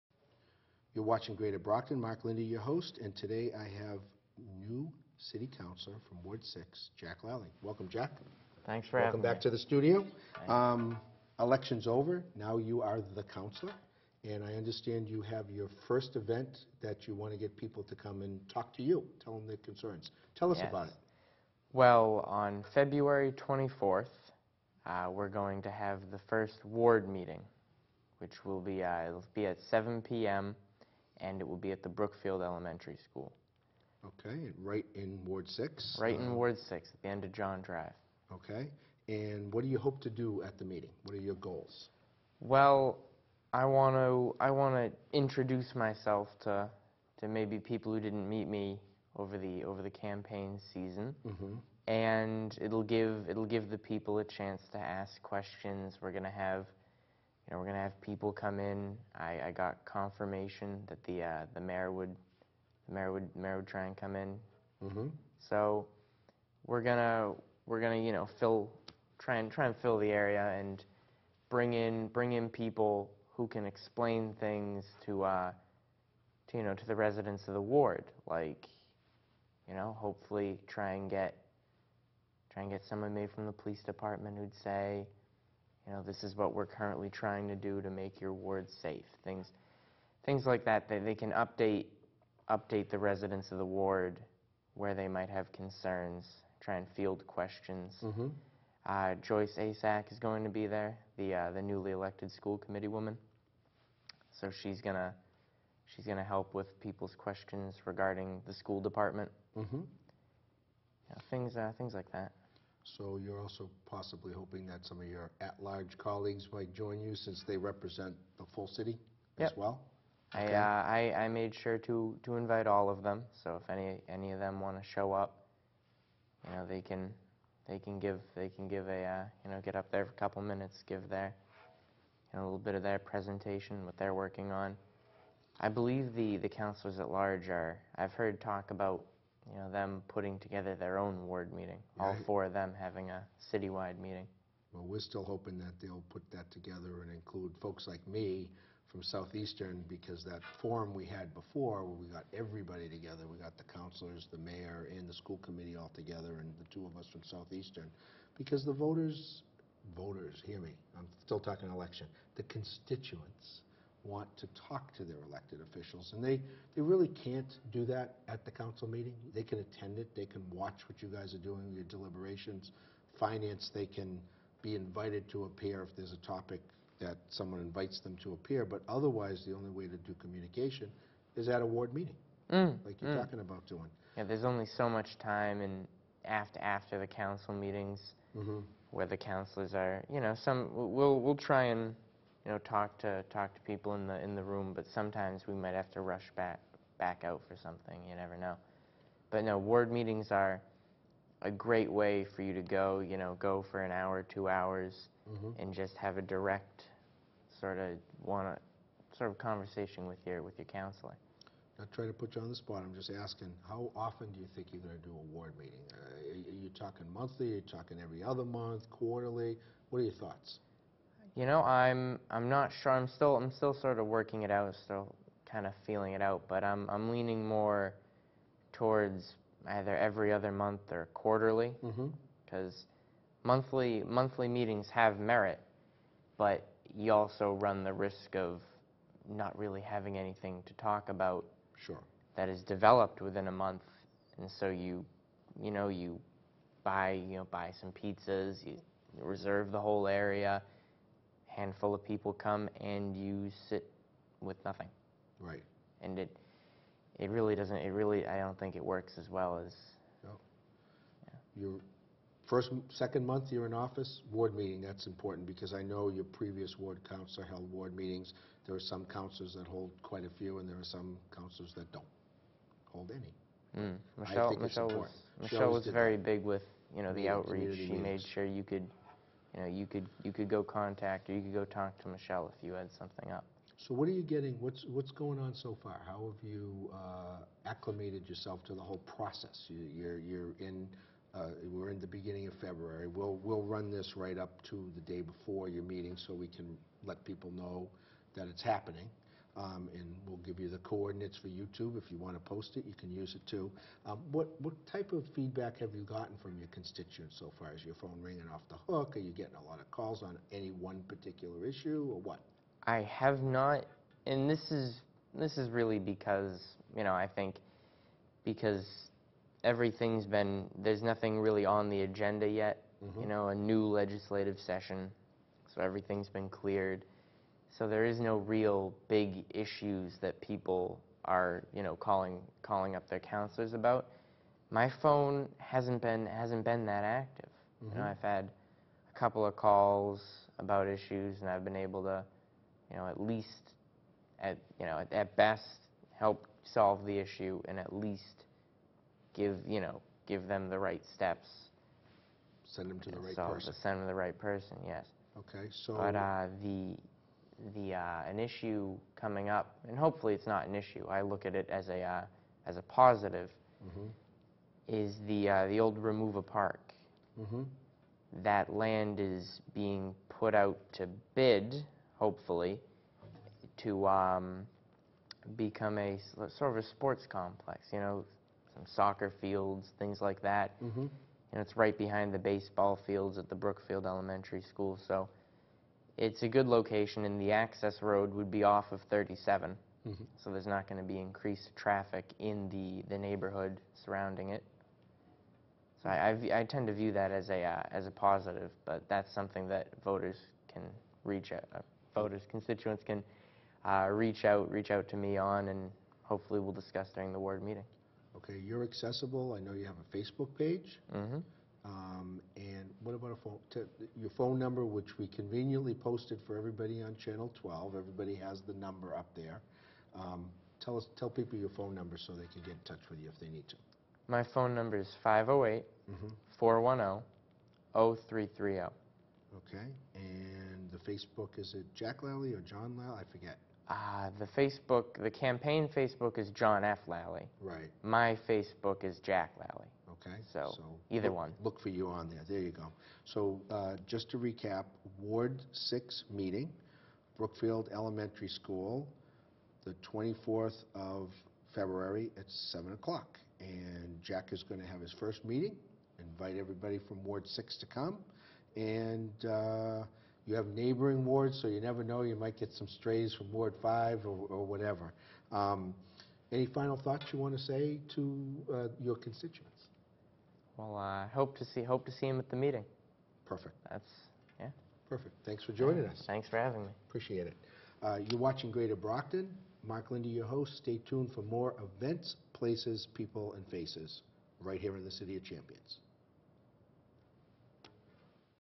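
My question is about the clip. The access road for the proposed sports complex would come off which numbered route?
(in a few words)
37.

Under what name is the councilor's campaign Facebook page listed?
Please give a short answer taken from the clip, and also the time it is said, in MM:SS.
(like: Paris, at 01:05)
John F. Lally, at 07:16.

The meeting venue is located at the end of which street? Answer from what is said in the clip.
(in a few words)
John Drive.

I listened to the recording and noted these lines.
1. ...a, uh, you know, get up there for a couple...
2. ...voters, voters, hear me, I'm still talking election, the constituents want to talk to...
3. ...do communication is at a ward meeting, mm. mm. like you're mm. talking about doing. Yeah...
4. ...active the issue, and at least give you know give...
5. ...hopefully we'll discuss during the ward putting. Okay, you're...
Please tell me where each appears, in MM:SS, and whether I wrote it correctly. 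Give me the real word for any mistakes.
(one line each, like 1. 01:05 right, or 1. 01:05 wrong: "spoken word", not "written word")
1. 02:08 right
2. 02:38 right
3. 02:59 right
4. 05:46 wrong: "solve", not "active"
5. 06:46 wrong: "meeting", not "putting".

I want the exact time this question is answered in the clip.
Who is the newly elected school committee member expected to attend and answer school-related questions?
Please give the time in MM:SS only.
01:39.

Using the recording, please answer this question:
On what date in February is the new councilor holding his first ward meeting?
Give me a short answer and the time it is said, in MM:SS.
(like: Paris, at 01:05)
February 24th, at 00:22.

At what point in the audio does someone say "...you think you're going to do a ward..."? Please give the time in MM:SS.
03:34.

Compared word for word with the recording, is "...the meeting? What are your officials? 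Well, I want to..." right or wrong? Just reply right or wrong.
wrong.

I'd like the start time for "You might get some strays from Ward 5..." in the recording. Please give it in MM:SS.
07:42.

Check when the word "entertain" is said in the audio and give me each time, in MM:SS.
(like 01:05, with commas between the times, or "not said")
not said.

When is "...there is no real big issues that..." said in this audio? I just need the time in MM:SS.
05:27.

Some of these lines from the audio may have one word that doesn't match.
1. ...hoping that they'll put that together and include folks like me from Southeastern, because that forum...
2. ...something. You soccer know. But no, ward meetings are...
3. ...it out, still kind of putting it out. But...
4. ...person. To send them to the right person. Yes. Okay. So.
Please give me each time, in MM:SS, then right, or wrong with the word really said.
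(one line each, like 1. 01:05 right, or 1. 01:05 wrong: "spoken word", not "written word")
1. 02:25 right
2. 03:17 wrong: "never", not "soccer"
3. 03:44 wrong: "feeling", not "putting"
4. 05:53 right.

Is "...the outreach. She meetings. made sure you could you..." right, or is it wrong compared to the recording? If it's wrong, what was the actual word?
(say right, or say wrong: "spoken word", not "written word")
right.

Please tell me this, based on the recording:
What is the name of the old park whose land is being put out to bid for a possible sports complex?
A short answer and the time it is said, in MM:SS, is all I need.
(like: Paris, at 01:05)
Romuva Park, at 06:05.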